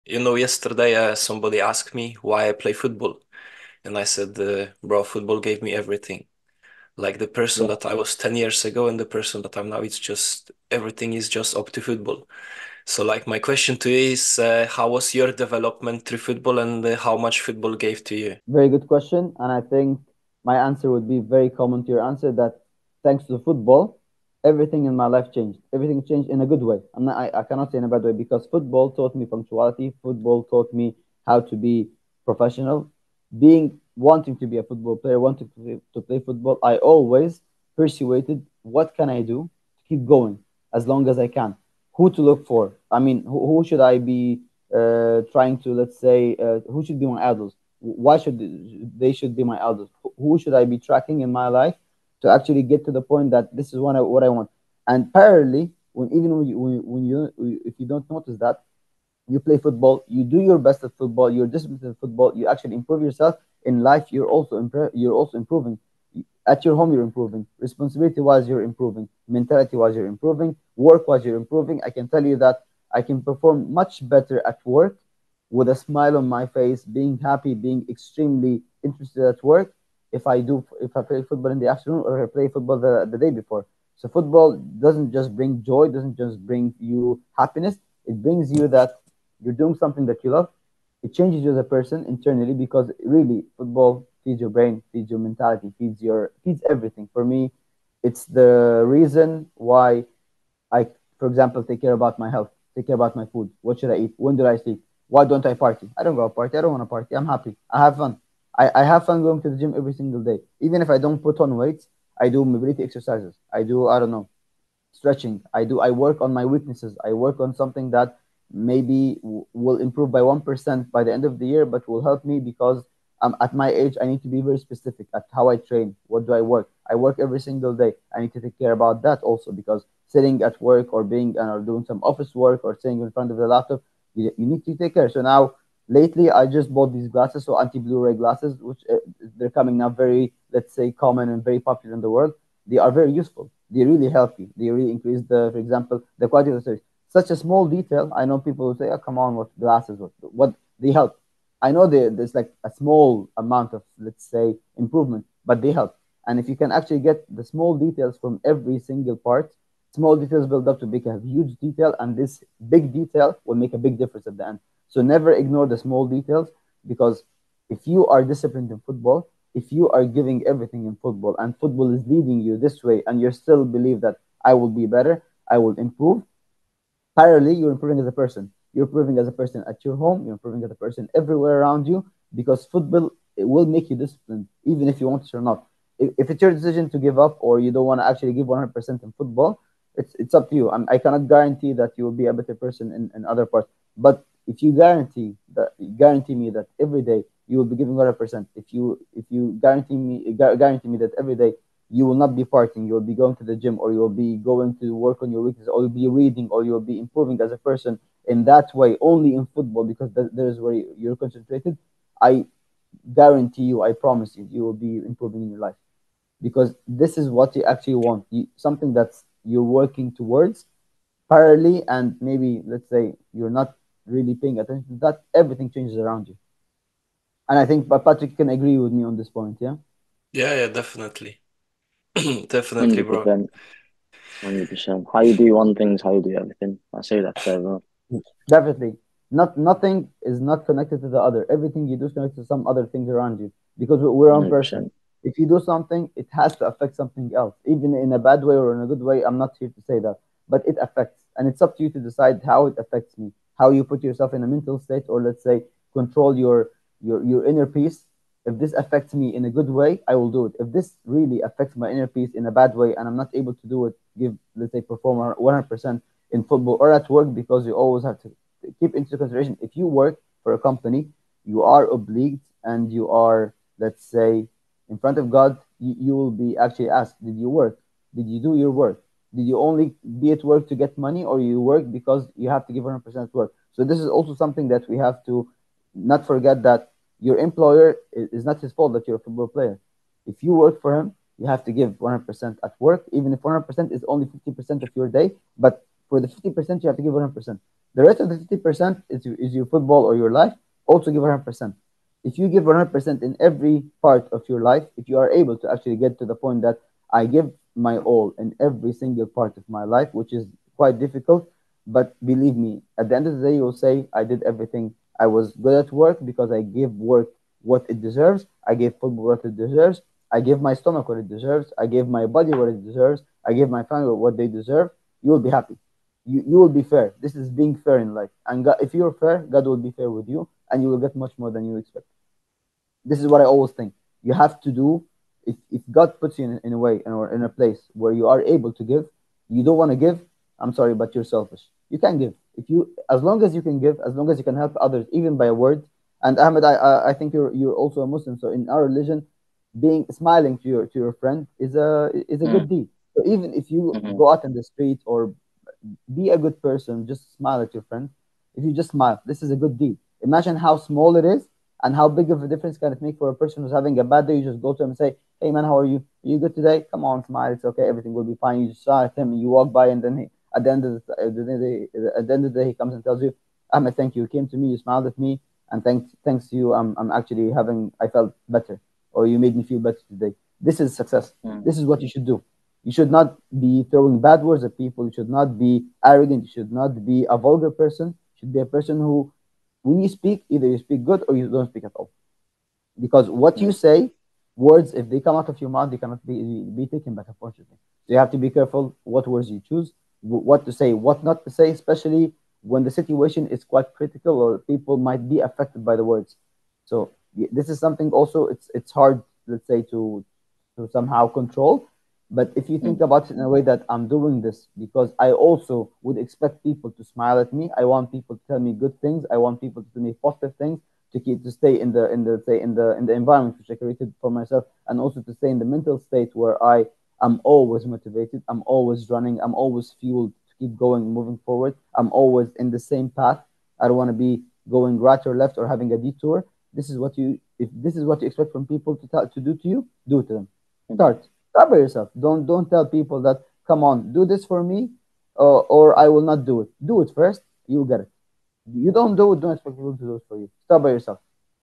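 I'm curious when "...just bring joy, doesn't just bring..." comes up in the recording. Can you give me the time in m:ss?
1:25.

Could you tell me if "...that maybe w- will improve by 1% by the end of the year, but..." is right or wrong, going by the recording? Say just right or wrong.
right.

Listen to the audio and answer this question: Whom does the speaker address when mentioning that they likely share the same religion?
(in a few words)
Ahmed.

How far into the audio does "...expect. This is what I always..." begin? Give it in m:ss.
5:31.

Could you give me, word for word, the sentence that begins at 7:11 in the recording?
I'm always in the same path.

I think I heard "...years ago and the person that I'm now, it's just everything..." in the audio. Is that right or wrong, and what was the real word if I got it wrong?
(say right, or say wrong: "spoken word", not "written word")
right.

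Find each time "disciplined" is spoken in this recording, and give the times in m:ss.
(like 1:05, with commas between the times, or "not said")
1:01, 2:48, 3:03.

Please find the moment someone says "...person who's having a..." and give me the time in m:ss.
6:03.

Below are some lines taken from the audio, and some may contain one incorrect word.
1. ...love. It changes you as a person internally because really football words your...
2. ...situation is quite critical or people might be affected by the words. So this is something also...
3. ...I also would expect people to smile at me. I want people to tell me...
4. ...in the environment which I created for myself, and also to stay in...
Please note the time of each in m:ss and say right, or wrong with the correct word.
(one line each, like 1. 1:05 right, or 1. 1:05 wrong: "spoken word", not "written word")
1. 1:30 wrong: "feeds", not "words"
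2. 6:42 right
3. 6:55 right
4. 7:02 right.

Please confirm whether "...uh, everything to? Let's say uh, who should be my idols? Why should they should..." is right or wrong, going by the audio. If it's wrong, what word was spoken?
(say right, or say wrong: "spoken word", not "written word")
wrong: "trying", not "everything".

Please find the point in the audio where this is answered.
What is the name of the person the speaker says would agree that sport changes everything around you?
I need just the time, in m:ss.
3:47.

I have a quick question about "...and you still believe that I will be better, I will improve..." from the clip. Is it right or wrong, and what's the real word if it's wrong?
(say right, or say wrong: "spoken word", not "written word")
right.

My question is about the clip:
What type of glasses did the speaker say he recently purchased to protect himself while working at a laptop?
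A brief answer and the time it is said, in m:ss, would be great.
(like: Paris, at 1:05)
Anti-blue-ray glasses, at 2:17.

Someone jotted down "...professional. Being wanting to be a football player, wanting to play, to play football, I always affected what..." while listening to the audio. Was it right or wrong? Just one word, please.
wrong.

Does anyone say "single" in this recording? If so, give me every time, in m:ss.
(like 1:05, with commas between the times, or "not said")
1:49, 2:07, 2:38, 5:08.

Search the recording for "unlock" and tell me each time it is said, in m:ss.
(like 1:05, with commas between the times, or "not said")
not said.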